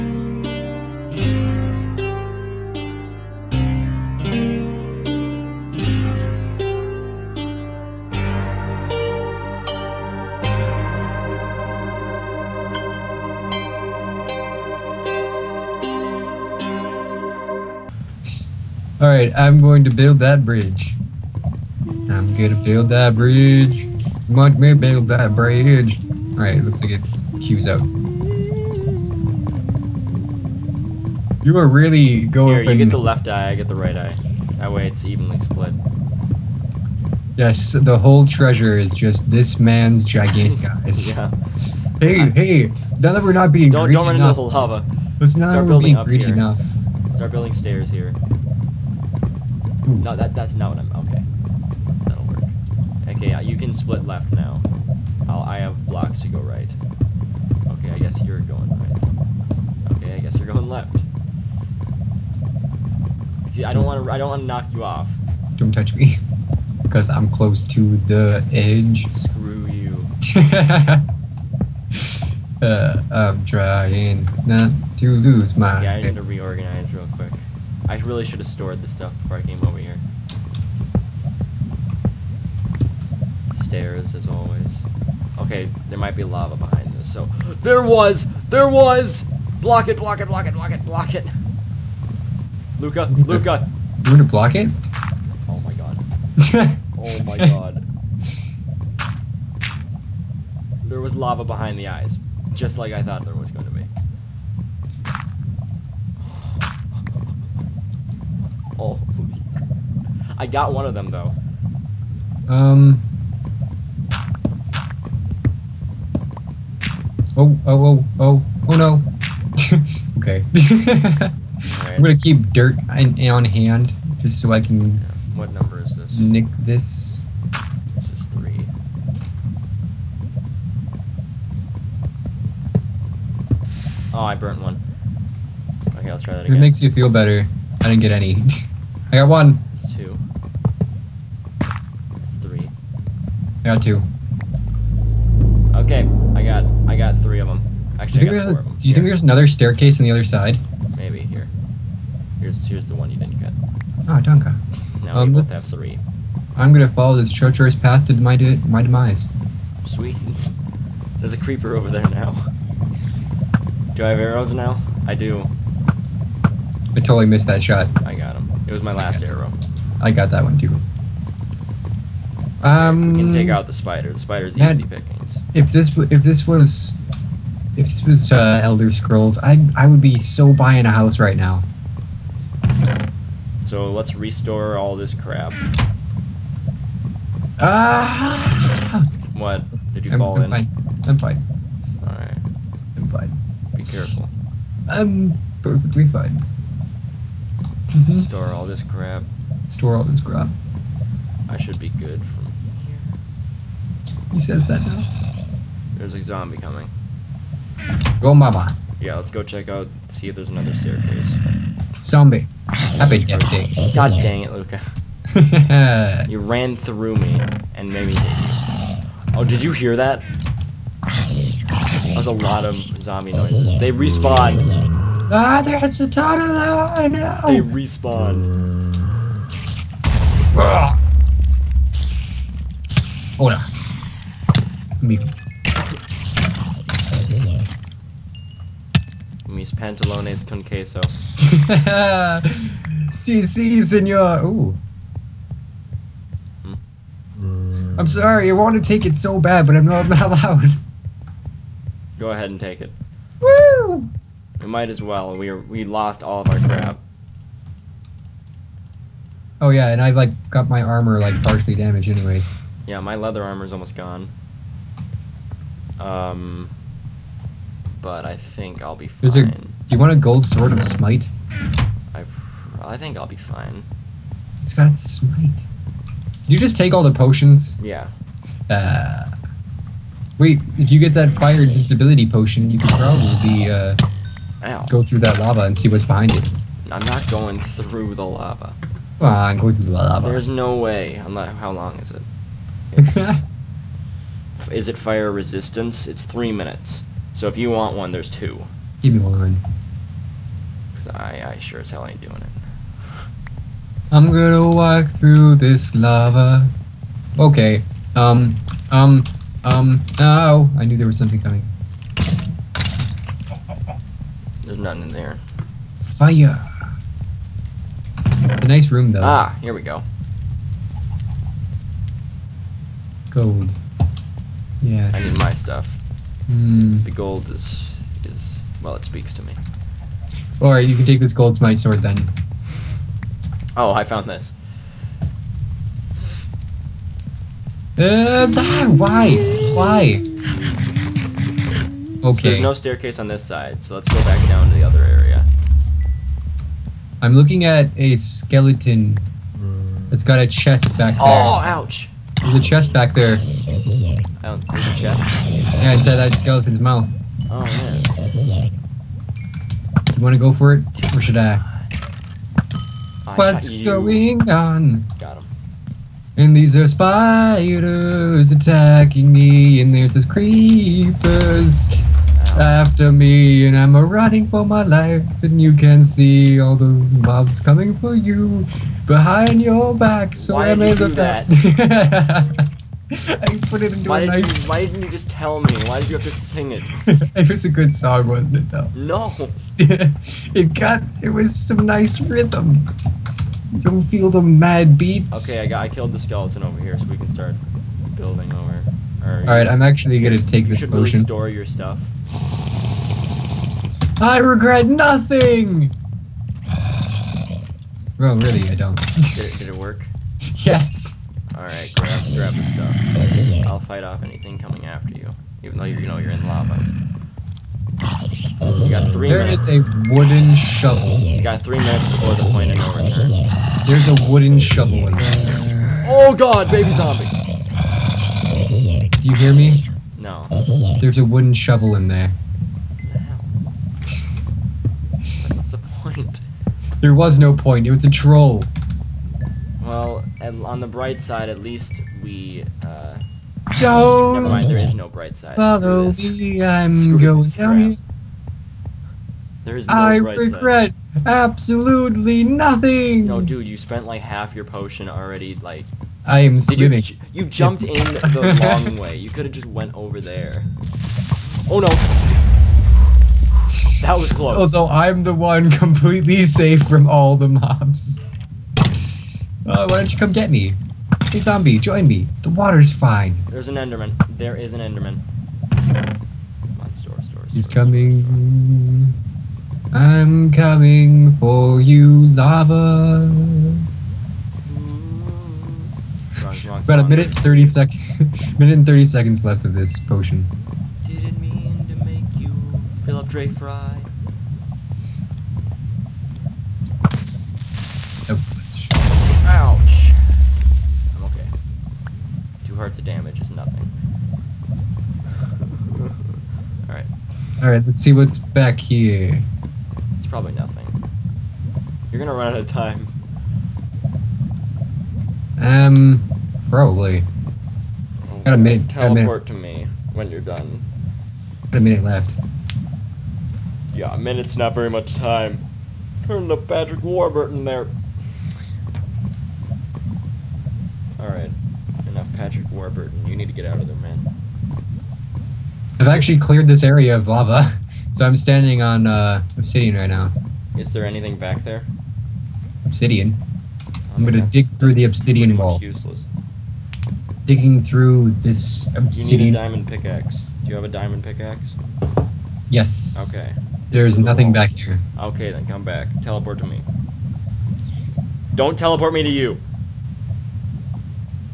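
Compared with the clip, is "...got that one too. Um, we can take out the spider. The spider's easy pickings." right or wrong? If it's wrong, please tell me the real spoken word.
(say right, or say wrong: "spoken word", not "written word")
right.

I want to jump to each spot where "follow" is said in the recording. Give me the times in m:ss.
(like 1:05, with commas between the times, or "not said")
2:36, 7:25.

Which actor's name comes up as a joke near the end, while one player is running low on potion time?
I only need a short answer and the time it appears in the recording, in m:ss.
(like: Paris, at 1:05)
Patrick Warburton, at 8:46.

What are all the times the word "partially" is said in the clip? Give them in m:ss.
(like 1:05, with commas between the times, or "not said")
4:21.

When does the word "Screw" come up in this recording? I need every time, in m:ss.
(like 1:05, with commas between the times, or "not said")
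1:09, 7:26.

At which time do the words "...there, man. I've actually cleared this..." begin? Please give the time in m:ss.
8:53.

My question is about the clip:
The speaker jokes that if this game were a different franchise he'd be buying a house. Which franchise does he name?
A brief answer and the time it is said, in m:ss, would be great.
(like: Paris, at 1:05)
Elder Scrolls, at 2:58.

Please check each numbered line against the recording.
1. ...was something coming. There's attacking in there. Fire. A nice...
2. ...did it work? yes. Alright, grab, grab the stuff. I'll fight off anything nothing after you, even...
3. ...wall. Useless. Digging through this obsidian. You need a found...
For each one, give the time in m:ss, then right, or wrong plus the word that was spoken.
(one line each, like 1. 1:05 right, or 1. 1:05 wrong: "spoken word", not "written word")
1. 5:11 wrong: "nothing", not "attacking"
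2. 6:49 wrong: "coming", not "nothing"
3. 9:05 wrong: "diamond", not "found".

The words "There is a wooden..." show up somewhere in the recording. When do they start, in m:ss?
6:59.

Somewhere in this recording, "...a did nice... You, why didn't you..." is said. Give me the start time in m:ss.
6:24.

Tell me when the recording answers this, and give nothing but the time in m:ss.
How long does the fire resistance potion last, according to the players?
4:56.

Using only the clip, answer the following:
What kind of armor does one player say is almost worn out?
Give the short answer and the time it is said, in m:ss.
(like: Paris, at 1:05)
leather armor, at 4:23.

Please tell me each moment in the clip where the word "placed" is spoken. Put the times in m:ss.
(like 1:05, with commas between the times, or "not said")
not said.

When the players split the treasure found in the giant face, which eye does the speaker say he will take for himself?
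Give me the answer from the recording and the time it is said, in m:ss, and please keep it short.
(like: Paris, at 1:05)
right eye, at 0:33.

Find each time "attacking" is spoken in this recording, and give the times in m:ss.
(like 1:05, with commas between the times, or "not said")
6:08.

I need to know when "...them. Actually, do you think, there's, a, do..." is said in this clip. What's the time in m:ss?
2:27.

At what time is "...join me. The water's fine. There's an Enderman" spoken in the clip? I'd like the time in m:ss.
7:51.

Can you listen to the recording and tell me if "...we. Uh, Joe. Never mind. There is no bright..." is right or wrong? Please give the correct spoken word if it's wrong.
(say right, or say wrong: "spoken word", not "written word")
right.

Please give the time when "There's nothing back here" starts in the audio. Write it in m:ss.
9:13.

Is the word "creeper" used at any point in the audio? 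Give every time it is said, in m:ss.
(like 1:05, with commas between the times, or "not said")
2:41, 6:10.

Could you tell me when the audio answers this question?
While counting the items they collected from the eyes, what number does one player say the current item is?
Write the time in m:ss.
2:07.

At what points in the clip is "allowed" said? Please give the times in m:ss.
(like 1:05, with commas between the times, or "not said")
4:10.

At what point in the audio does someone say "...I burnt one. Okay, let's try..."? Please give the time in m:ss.
2:14.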